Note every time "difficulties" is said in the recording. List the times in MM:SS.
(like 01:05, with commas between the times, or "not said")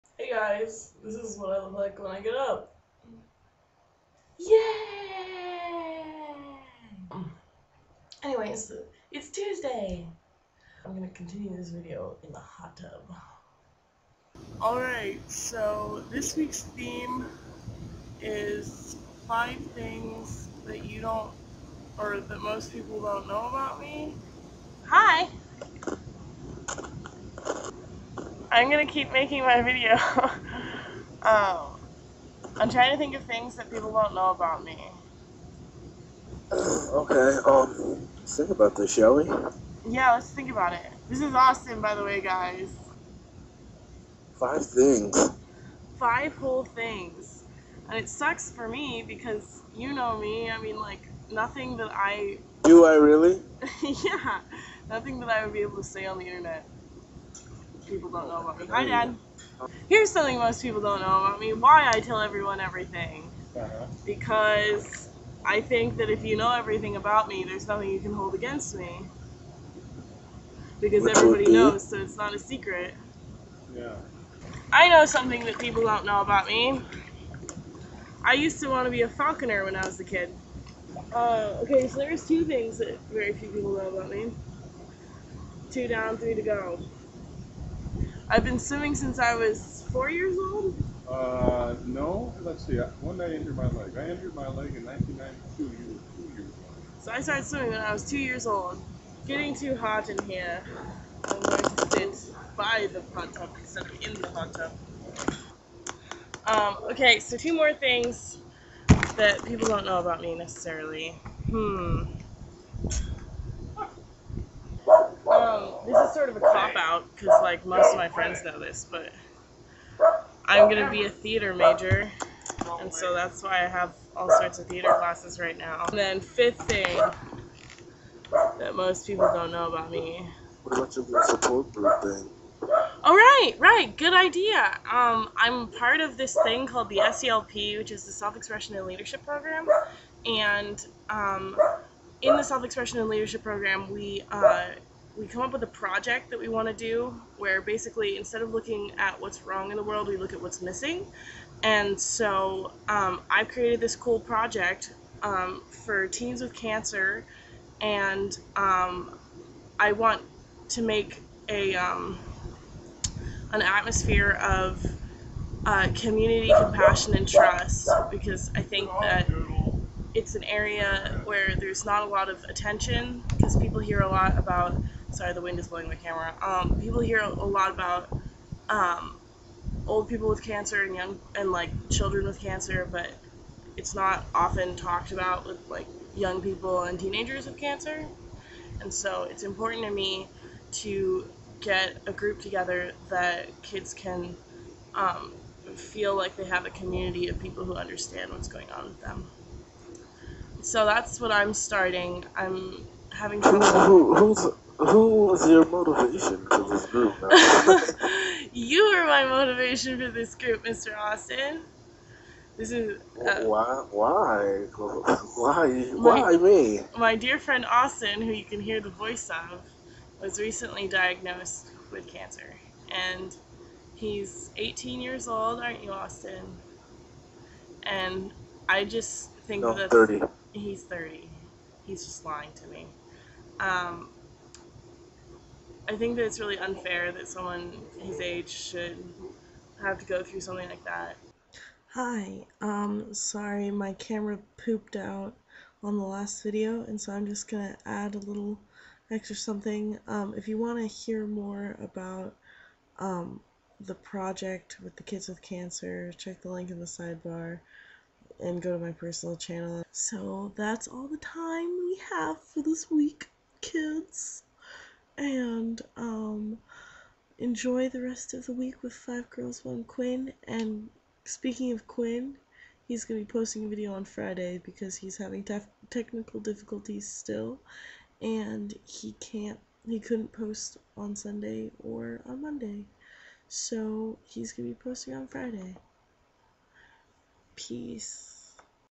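04:36.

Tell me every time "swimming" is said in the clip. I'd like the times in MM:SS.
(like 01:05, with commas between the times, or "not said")
01:28, 01:37.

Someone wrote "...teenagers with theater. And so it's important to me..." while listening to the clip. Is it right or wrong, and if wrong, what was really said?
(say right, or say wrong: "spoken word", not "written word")
wrong: "cancer", not "theater".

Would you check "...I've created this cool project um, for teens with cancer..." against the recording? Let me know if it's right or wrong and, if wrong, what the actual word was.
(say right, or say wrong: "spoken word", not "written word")
right.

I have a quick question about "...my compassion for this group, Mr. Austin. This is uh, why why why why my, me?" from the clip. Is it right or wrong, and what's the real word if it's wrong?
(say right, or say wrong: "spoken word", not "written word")
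wrong: "motivation", not "compassion".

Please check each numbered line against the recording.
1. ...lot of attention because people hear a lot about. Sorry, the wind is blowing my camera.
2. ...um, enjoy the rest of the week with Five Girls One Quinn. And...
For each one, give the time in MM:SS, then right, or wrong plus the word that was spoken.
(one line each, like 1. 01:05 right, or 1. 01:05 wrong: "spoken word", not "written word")
1. 02:52 right
2. 04:25 right.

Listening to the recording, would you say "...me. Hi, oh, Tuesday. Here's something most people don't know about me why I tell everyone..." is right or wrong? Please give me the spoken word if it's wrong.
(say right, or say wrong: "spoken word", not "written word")
wrong: "Dad", not "Tuesday".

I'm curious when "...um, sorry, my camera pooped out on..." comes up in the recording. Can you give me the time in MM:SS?
04:02.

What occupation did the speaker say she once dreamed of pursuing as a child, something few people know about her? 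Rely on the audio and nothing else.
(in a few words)
Falconer.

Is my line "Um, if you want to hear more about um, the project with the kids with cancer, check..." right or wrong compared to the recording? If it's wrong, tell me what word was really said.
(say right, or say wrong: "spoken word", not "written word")
right.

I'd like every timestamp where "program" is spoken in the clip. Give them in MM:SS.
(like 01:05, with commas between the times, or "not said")
02:19, 02:23.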